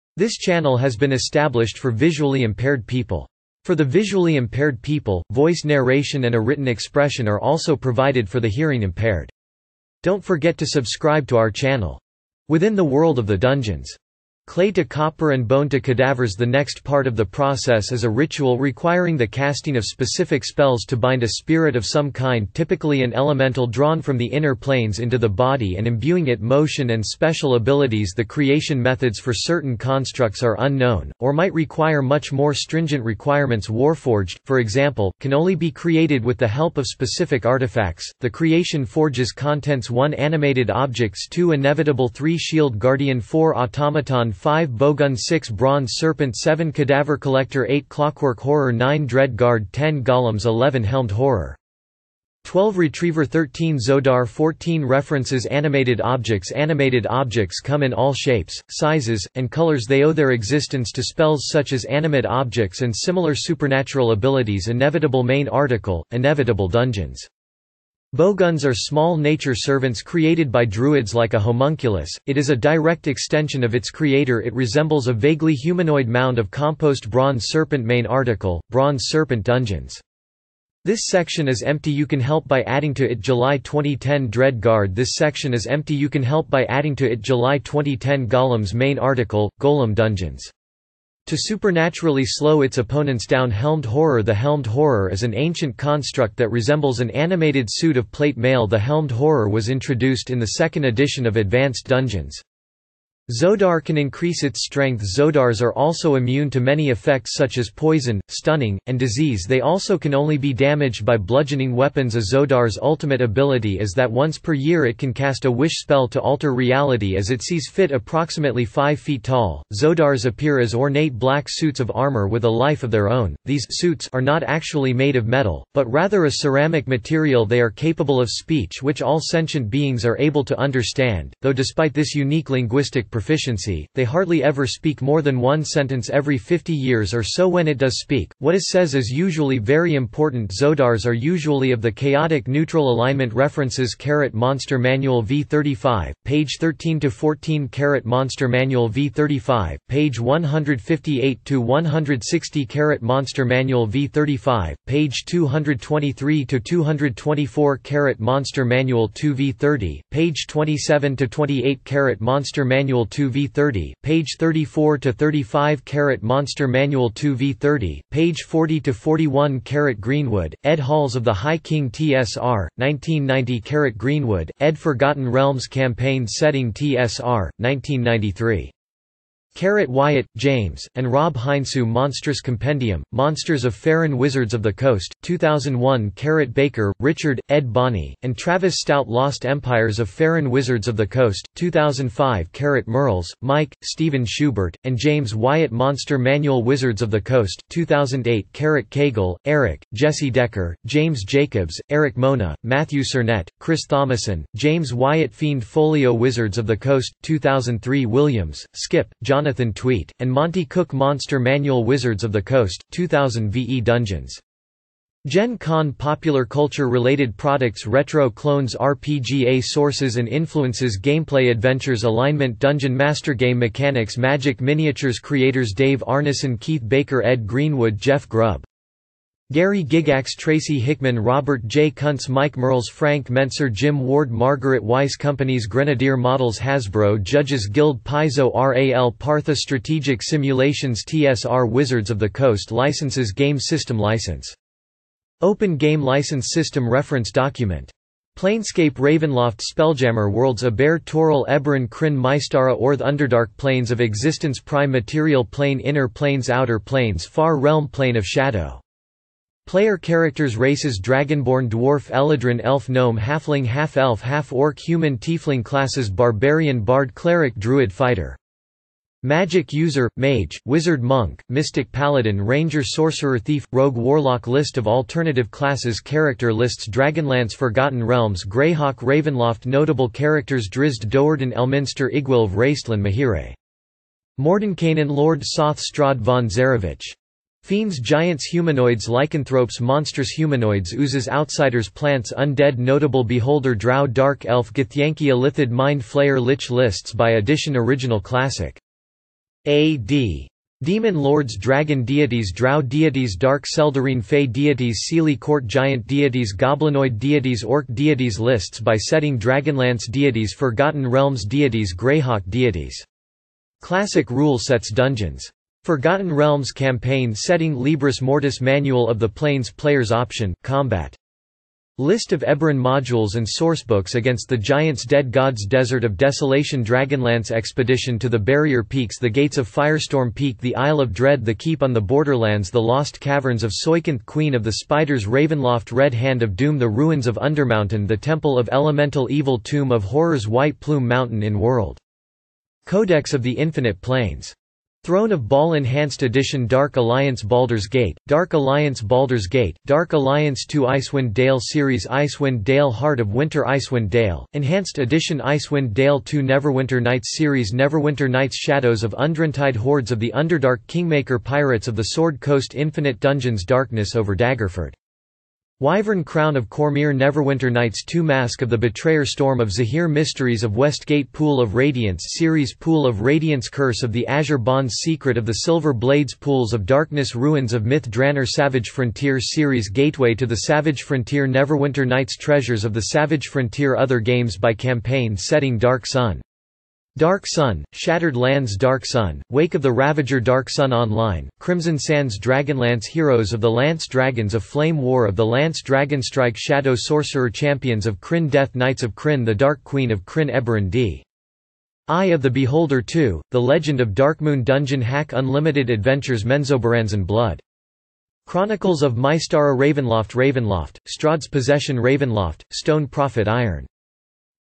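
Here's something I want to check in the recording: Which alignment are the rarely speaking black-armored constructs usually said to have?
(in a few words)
Chaotic neutral.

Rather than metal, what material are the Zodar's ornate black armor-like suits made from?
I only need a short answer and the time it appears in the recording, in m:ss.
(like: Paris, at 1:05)
Ceramic, at 2:06.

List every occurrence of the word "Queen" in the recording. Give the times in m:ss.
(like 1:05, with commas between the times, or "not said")
5:34, 6:39.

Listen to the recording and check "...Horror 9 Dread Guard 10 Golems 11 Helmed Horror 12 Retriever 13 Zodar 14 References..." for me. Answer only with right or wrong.
right.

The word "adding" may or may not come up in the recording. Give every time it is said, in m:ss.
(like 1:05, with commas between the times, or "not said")
1:22, 1:26.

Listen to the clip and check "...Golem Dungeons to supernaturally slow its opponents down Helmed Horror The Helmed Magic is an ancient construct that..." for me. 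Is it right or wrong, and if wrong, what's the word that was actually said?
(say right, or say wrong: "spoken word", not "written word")
wrong: "Horror", not "Magic".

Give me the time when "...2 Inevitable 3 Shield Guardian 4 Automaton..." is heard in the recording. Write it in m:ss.
0:41.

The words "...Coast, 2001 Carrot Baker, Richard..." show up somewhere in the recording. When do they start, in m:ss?
3:04.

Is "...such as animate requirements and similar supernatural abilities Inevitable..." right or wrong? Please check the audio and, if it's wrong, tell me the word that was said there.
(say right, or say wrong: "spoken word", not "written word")
wrong: "objects", not "requirements".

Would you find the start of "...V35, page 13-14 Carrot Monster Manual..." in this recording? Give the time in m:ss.
2:25.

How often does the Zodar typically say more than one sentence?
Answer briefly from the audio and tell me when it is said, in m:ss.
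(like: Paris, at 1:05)
Every 50 years, at 2:16.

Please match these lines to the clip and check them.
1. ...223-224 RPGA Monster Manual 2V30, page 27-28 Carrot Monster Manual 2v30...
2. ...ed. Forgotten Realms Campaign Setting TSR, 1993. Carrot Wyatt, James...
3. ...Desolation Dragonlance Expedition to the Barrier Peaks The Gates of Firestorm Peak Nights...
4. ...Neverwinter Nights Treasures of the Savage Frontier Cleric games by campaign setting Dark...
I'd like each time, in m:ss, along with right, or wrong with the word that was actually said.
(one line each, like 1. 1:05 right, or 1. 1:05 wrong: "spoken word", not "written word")
1. 2:35 wrong: "Carrot", not "RPGA"
2. 2:54 right
3. 5:26 wrong: "The", not "Nights"
4. 6:21 wrong: "Other", not "Cleric".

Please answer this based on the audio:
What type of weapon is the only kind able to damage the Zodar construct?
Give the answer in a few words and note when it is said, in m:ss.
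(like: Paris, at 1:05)
Bludgeoning weapons, at 1:51.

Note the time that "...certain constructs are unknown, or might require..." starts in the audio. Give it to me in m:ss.
0:29.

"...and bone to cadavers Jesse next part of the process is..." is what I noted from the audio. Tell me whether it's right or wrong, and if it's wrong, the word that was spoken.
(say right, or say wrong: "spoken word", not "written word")
wrong: "The", not "Jesse".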